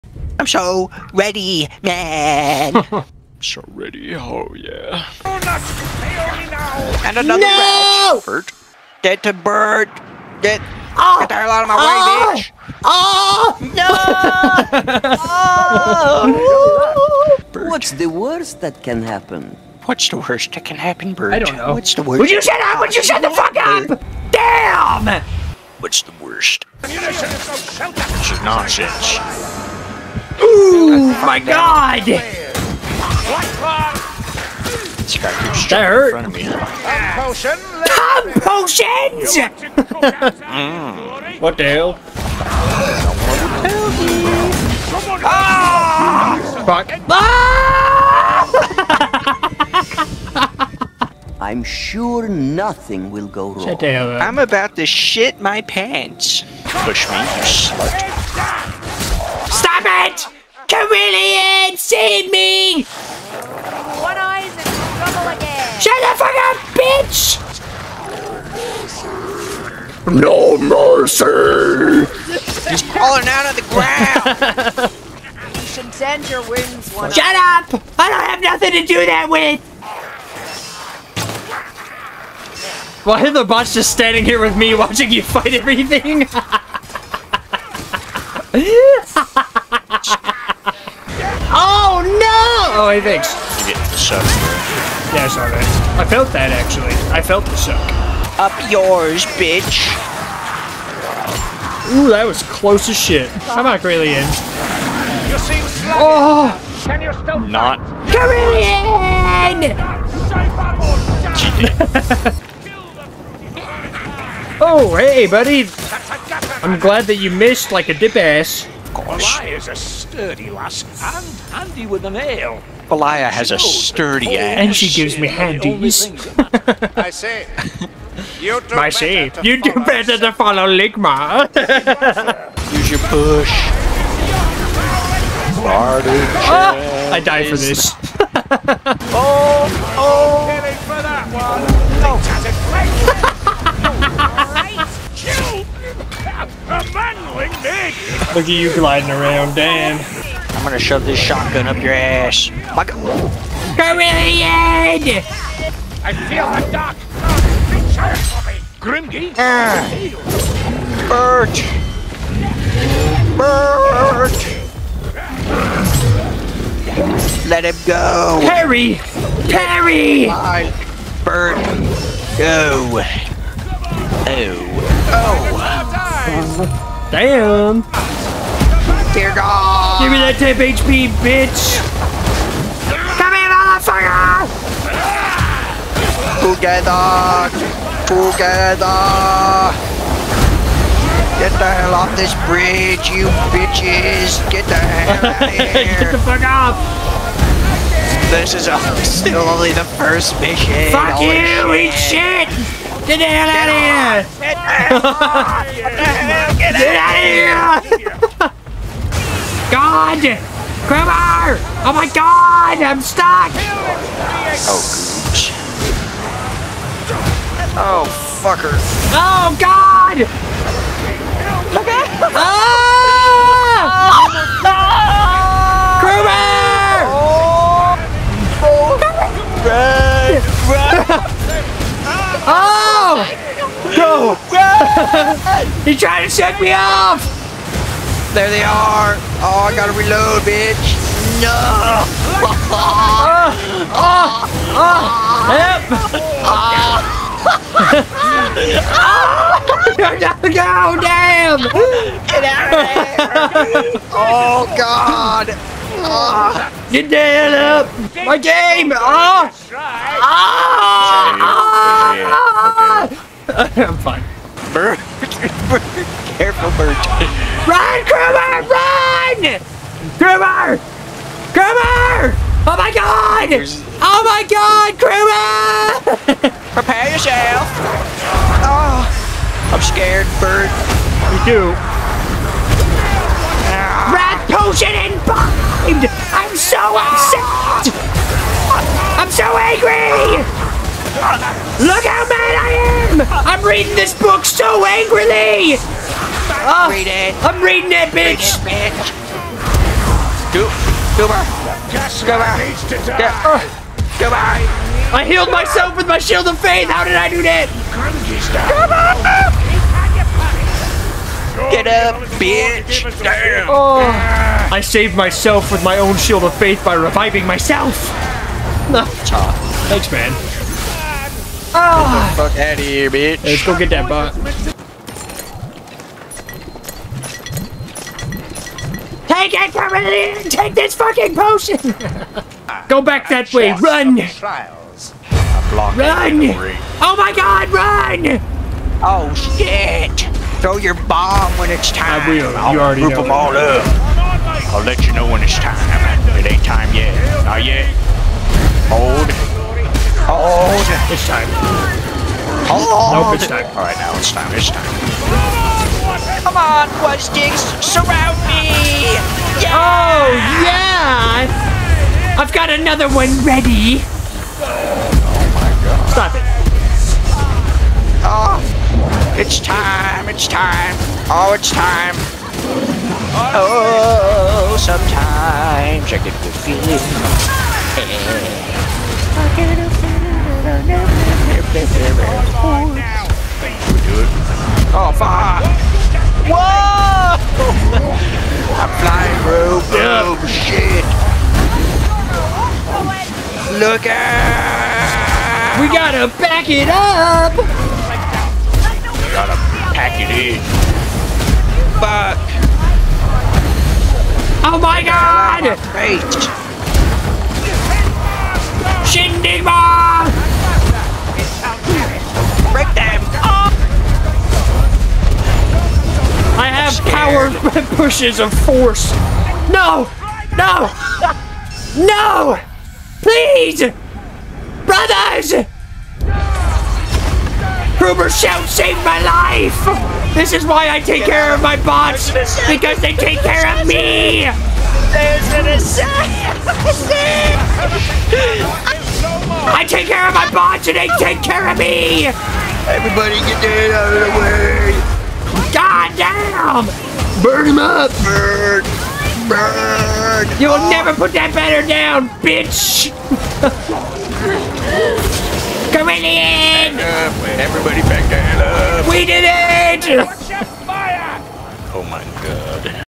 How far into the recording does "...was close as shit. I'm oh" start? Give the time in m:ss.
1:42.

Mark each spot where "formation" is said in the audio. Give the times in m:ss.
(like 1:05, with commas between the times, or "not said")
not said.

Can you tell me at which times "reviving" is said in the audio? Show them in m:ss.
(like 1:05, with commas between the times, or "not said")
5:16.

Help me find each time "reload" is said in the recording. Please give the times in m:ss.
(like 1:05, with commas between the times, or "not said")
3:59.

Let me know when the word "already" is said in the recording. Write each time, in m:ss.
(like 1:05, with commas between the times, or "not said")
5:42.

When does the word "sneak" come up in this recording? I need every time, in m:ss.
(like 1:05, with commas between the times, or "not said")
not said.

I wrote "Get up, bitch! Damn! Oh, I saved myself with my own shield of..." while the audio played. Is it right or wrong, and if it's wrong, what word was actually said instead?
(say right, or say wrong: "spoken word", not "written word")
right.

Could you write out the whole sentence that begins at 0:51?
I'm sure nothing will go wrong.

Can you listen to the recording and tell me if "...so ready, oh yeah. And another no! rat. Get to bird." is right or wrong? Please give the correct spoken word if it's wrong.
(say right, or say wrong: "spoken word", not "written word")
right.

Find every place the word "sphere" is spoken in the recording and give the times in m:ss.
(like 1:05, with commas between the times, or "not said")
not said.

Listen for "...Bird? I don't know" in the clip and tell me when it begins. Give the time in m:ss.
0:21.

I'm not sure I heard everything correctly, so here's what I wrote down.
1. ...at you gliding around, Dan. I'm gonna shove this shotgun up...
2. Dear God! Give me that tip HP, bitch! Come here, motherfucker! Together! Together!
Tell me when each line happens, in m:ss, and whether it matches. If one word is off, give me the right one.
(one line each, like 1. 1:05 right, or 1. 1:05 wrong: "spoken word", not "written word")
1. 2:28 right
2. 2:59 right.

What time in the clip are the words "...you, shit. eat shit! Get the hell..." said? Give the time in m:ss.
3:21.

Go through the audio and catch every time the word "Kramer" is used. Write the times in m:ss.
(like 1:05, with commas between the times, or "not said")
3:30, 3:46.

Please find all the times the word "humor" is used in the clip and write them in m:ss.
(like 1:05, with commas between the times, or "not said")
not said.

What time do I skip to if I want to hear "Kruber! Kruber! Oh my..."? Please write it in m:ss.
4:30.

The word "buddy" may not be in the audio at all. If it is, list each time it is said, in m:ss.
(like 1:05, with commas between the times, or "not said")
1:55.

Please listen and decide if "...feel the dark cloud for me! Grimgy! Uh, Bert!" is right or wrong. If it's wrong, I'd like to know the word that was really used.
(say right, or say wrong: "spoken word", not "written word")
right.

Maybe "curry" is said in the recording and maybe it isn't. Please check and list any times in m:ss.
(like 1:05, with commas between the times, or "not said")
not said.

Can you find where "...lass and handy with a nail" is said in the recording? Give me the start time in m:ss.
2:00.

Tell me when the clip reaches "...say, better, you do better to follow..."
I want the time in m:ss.
2:08.